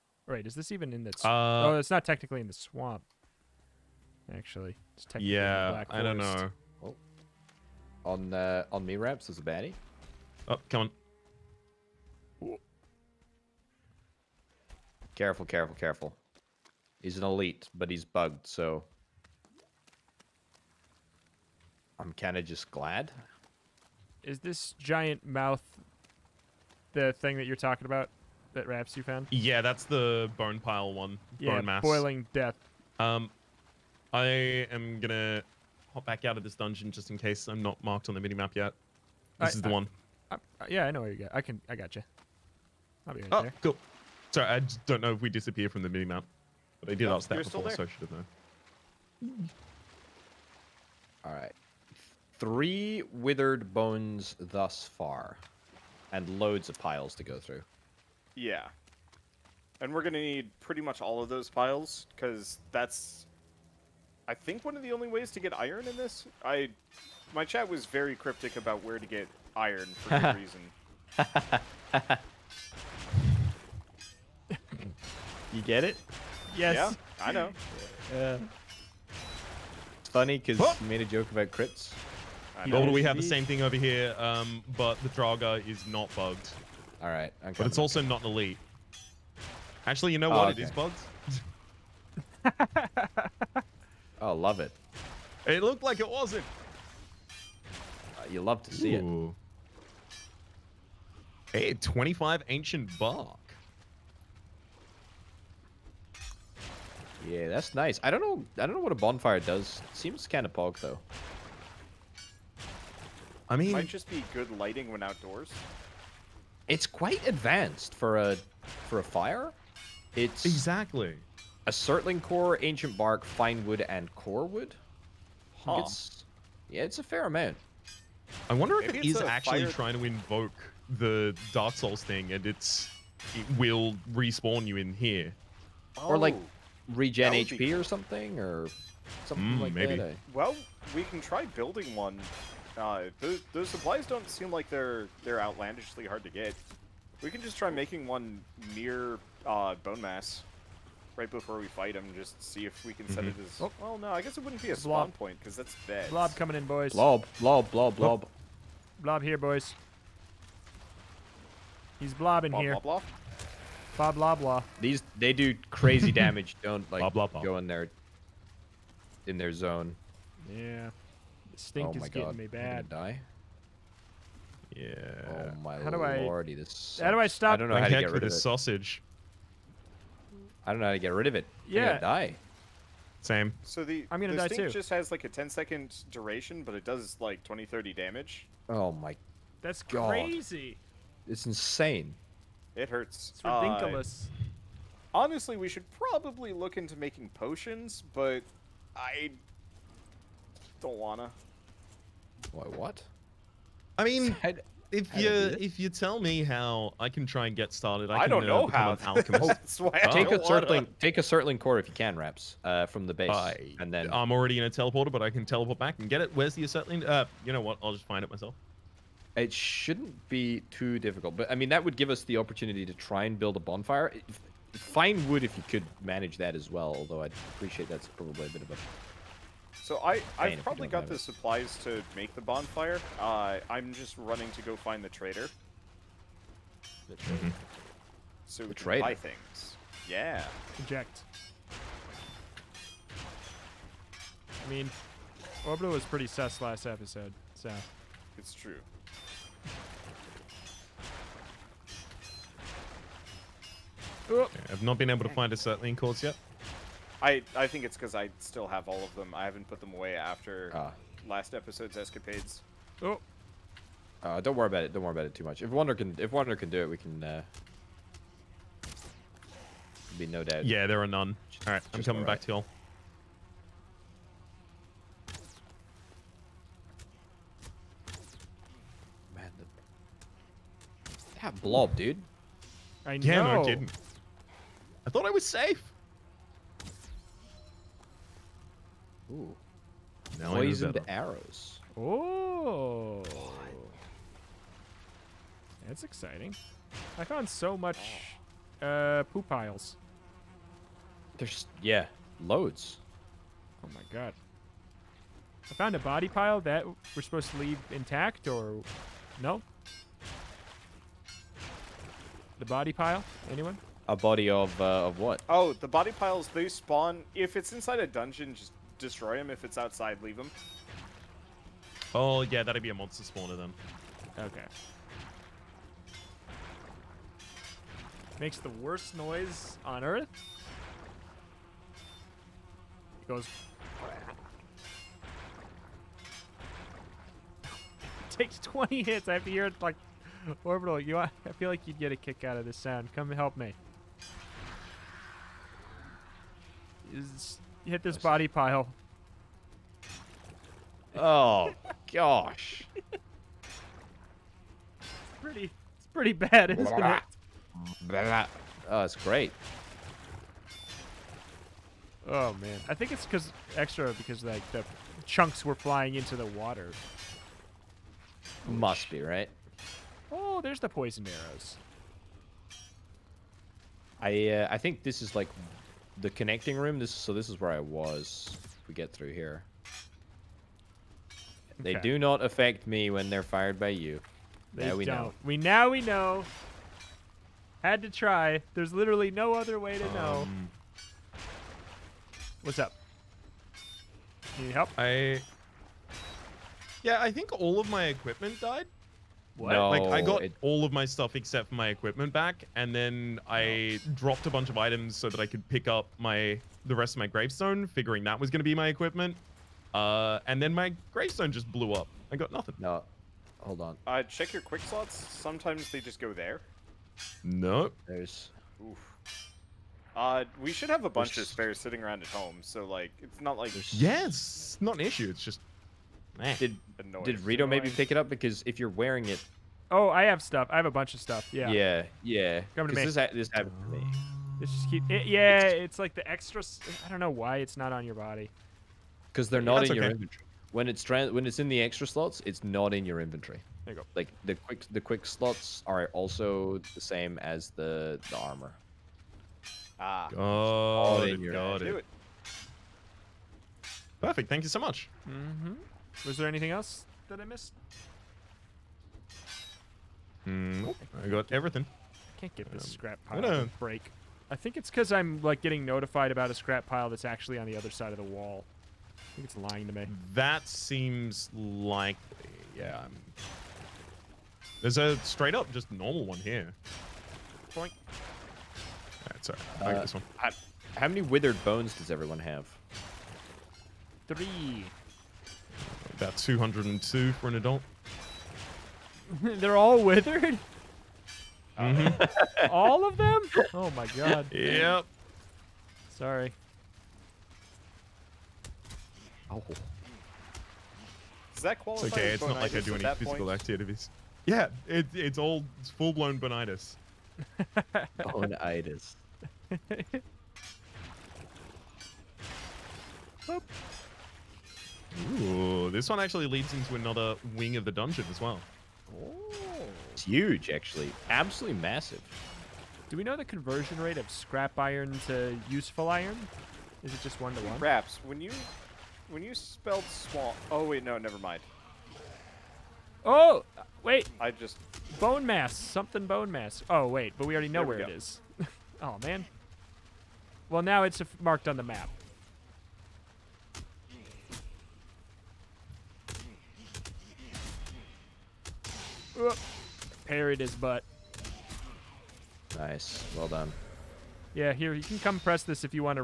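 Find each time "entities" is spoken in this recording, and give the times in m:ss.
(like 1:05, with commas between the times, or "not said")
not said.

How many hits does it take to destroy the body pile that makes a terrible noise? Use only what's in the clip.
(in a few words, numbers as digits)
20.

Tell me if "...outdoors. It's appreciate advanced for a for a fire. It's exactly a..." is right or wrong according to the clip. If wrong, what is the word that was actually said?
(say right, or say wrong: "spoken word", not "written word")
wrong: "quite", not "appreciate".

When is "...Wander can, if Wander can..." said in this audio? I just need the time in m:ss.
4:25.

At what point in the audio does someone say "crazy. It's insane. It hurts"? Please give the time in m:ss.
3:10.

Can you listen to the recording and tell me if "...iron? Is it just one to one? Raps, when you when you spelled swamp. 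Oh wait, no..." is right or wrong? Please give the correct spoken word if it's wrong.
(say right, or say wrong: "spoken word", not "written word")
right.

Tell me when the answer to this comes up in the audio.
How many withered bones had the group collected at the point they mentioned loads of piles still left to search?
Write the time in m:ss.
0:52.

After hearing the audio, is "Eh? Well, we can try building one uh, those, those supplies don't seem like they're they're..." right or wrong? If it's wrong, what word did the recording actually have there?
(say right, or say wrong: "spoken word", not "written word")
right.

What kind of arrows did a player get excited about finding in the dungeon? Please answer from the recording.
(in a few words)
Poison arrows.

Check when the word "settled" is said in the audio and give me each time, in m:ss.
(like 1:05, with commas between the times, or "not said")
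not said.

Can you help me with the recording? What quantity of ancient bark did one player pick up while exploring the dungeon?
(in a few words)
25.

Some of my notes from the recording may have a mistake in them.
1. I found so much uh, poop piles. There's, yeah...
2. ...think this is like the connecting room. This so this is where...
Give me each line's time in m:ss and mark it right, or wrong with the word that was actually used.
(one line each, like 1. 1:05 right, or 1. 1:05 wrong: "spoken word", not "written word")
1. 4:57 right
2. 6:14 right.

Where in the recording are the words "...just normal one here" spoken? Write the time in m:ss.
7:55.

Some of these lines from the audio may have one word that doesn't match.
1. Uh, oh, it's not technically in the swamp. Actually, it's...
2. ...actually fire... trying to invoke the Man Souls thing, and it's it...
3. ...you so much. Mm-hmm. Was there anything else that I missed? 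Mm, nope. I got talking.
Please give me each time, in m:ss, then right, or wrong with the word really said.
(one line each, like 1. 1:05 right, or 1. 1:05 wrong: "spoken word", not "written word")
1. 0:01 right
2. 2:09 wrong: "Dark", not "Man"
3. 7:34 wrong: "everything", not "talking".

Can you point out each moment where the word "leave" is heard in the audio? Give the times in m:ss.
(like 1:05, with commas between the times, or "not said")
5:07, 5:20.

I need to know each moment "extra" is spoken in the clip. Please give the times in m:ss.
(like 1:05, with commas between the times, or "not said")
6:03, 7:16, 7:21.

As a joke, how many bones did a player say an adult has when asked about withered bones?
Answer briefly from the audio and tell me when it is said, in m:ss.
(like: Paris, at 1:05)
202, at 8:06.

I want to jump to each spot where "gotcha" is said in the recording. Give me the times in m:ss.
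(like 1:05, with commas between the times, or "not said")
0:41.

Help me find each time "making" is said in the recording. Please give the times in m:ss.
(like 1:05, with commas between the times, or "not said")
2:27, 3:16.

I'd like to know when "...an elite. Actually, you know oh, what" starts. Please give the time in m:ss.
1:28.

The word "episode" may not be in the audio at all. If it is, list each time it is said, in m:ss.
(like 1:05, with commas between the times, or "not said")
4:06, 4:21.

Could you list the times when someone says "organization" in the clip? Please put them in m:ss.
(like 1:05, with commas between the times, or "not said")
not said.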